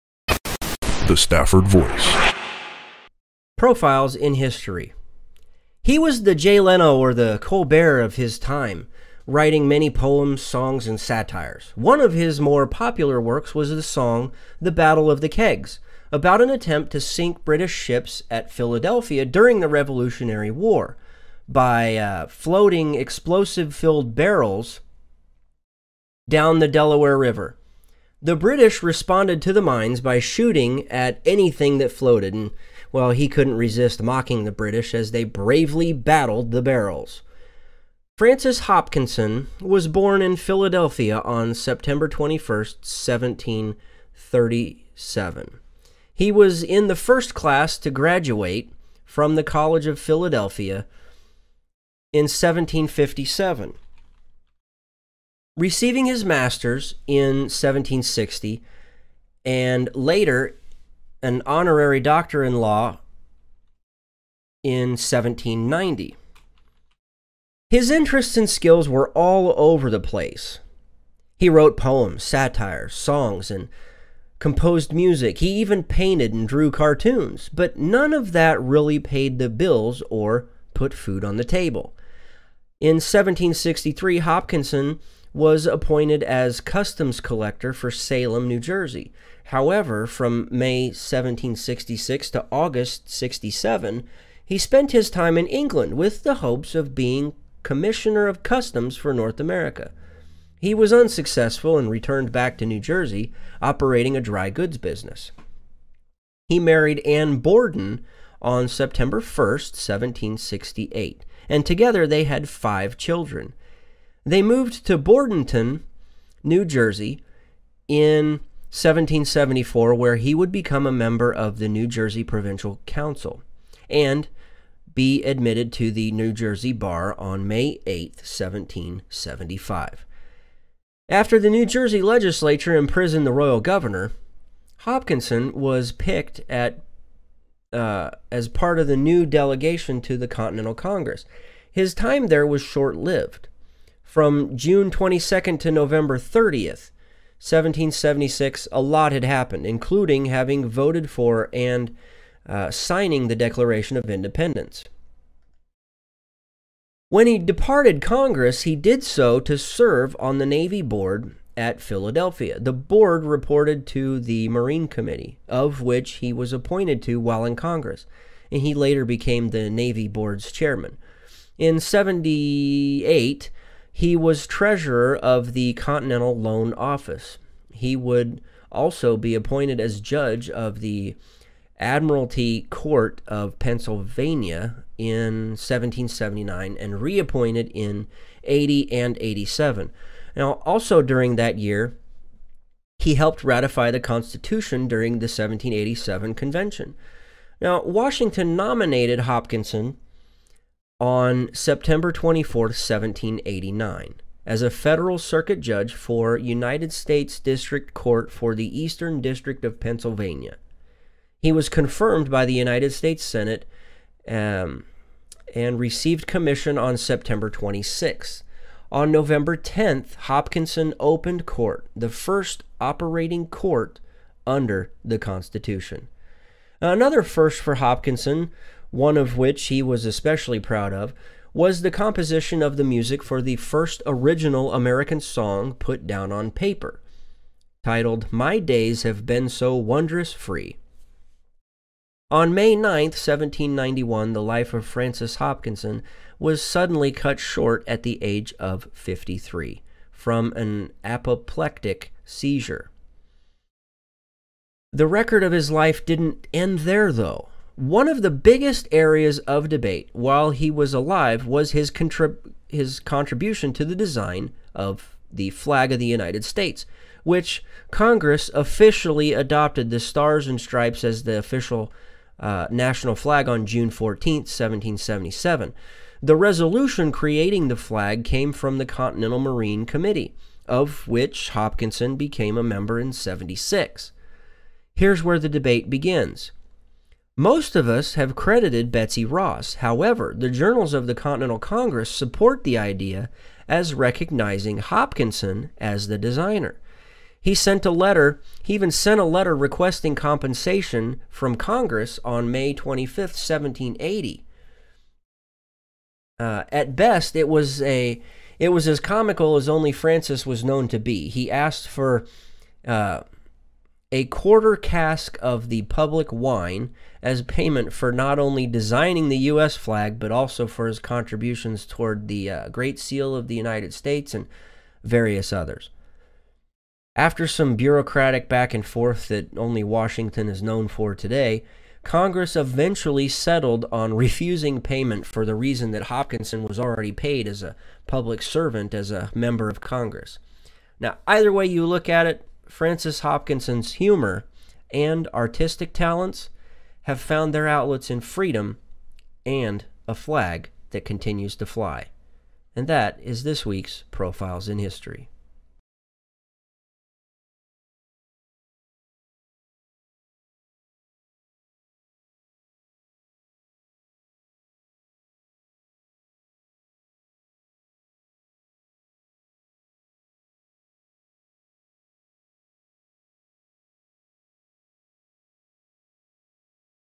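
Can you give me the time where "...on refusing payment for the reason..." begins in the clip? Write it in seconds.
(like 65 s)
333 s.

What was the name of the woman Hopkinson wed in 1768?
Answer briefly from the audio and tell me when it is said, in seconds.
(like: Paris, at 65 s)
Anne Borden, at 106 s.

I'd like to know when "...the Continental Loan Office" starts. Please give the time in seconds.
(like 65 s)
175 s.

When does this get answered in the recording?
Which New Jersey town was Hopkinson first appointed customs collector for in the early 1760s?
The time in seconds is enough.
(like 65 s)
87 s.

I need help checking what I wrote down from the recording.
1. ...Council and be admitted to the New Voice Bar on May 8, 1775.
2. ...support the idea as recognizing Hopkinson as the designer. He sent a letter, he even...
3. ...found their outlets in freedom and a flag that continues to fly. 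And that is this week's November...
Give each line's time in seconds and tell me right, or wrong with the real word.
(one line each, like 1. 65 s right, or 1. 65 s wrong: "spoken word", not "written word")
1. 122 s wrong: "Jersey", not "Voice"
2. 292 s right
3. 347 s wrong: "Profiles", not "November".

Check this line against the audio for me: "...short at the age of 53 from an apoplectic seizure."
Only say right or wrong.
right.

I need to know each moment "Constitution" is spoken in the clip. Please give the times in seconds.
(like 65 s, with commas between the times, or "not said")
193 s, 225 s.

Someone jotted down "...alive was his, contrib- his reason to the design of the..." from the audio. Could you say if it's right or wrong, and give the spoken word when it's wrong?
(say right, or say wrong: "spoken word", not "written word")
wrong: "contribution", not "reason".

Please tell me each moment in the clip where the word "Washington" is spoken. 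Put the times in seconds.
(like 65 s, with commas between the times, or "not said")
197 s, 329 s.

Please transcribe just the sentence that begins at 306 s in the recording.
Uh, at best, it was a it was as comical as only Francis was known to be.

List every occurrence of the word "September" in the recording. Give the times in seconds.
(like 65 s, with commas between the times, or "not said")
41 s, 108 s, 201 s, 216 s.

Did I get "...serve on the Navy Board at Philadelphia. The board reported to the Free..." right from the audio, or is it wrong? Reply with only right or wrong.
wrong.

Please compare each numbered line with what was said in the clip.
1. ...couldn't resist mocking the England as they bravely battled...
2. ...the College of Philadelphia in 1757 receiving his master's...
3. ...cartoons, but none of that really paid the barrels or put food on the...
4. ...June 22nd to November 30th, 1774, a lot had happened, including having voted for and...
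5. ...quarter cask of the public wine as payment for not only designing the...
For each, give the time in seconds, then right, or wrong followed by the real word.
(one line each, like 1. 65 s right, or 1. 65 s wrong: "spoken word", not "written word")
1. 33 s wrong: "British", not "England"
2. 49 s right
3. 76 s wrong: "bills", not "barrels"
4. 144 s wrong: "1776", not "1774"
5. 314 s right.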